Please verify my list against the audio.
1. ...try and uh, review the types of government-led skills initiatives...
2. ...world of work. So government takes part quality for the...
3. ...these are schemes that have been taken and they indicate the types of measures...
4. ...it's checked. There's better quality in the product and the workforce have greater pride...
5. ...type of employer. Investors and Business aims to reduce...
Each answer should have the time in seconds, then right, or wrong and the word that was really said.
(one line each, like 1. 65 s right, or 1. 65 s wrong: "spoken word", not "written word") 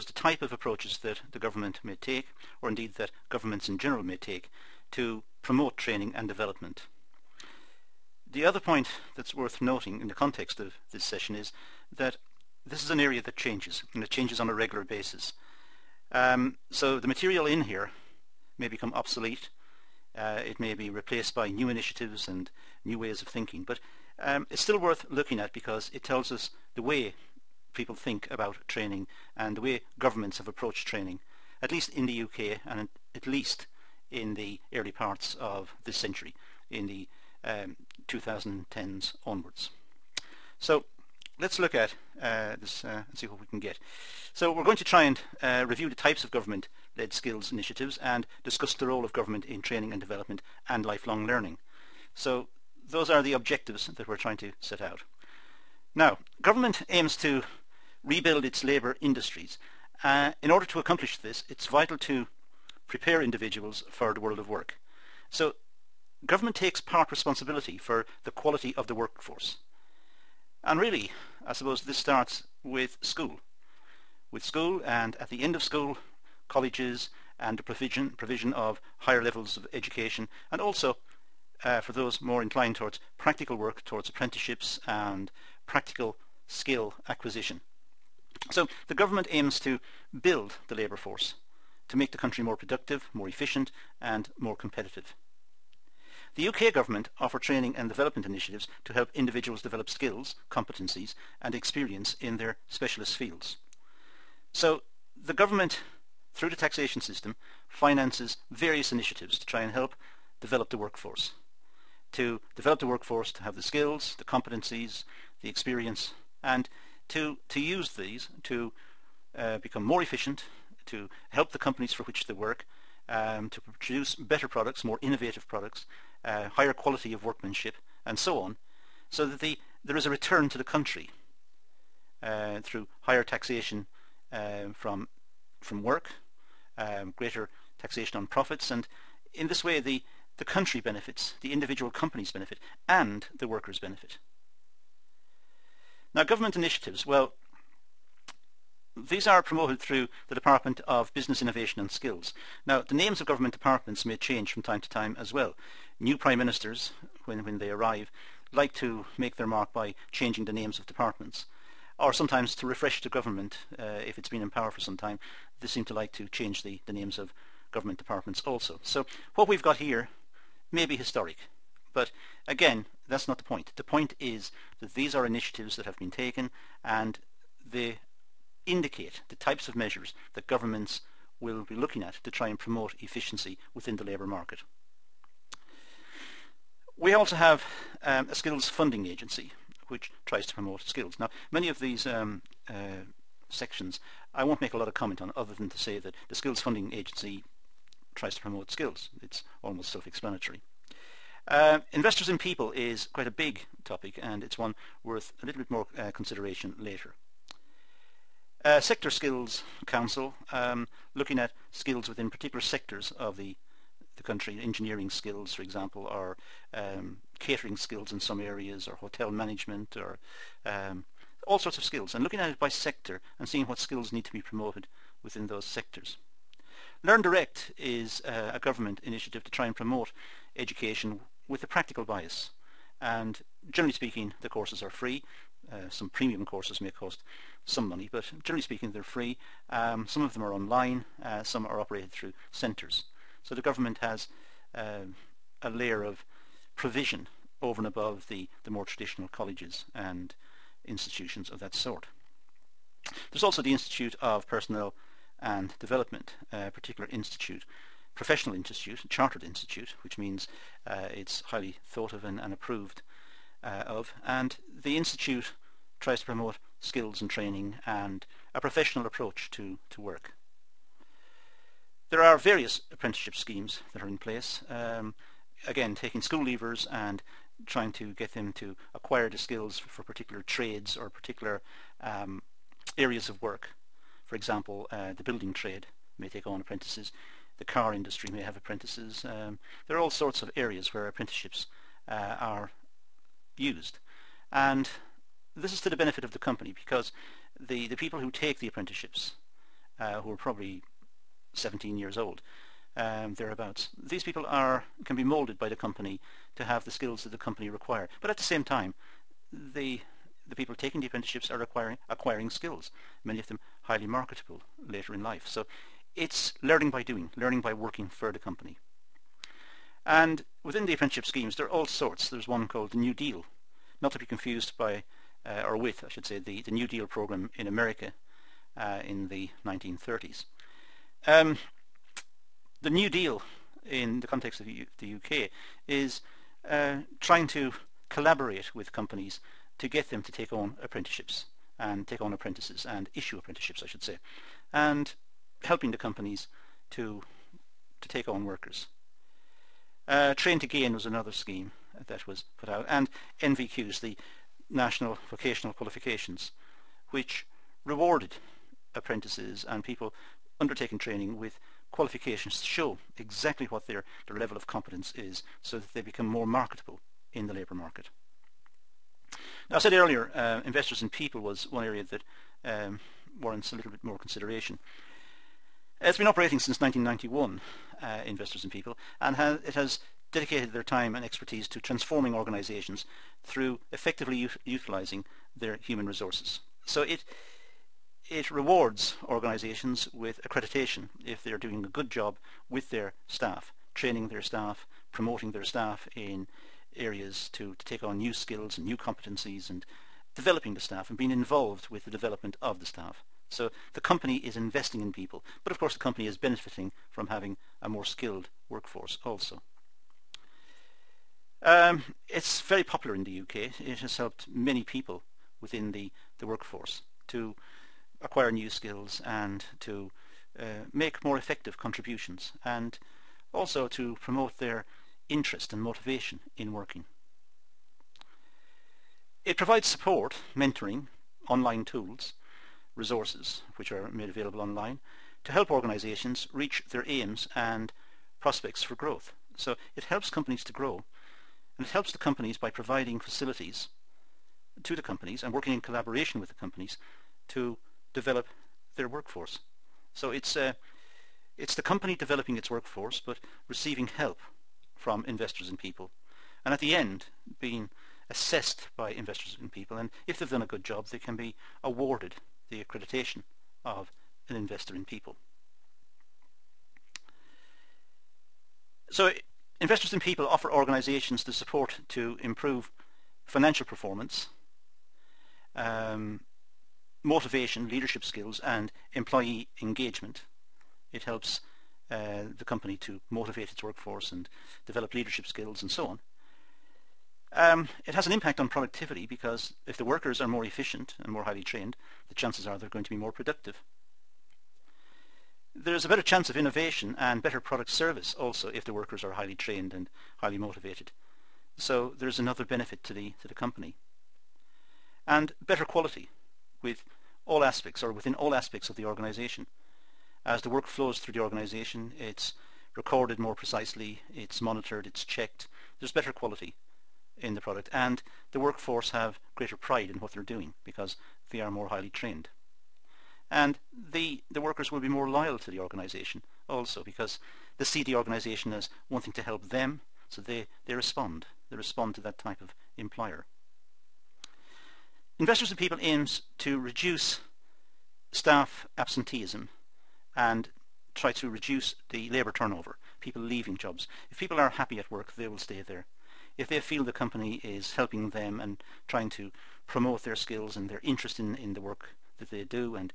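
1. 44 s right
2. 64 s wrong: "responsibility", not "quality"
3. 174 s wrong: "initiatives", not "schemes"
4. 515 s right
5. 532 s wrong: "People", not "Business".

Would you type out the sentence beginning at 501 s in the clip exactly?
So there's another benefit to the, to the company and better quality with all aspects or within all aspects of the organization.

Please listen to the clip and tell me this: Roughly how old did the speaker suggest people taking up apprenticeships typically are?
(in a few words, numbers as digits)
17.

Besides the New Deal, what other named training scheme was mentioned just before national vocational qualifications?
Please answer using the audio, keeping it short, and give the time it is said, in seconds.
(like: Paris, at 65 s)
Train to Gain, at 350 s.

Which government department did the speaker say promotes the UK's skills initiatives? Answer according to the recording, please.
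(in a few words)
Department of Business Innovation and Skills.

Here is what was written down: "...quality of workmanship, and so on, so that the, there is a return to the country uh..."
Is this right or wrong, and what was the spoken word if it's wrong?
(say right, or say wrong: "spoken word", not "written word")
right.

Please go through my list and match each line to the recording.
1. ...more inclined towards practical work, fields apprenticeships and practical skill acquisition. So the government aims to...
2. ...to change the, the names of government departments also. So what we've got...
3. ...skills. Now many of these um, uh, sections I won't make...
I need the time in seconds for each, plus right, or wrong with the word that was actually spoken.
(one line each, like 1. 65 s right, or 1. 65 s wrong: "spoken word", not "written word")
1. 82 s wrong: "towards", not "fields"
2. 166 s right
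3. 190 s right.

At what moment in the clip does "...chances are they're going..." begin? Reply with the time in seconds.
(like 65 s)
492 s.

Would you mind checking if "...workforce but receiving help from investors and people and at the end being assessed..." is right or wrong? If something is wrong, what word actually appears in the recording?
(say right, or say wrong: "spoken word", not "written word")
right.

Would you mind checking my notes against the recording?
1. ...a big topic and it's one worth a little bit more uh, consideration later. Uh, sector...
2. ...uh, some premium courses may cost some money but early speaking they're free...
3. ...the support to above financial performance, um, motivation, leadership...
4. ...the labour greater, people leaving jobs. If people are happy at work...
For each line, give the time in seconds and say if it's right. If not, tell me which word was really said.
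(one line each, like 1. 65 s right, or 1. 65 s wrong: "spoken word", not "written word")
1. 203 s right
2. 235 s wrong: "generally", not "early"
3. 471 s wrong: "improve", not "above"
4. 542 s wrong: "turnover", not "greater".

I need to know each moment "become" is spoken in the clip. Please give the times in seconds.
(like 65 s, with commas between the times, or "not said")
18 s, 119 s, 365 s.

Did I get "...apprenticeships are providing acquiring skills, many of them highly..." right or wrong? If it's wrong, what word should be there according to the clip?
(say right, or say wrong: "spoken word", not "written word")
wrong: "acquiring", not "providing".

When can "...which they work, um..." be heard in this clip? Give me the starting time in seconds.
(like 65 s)
122 s.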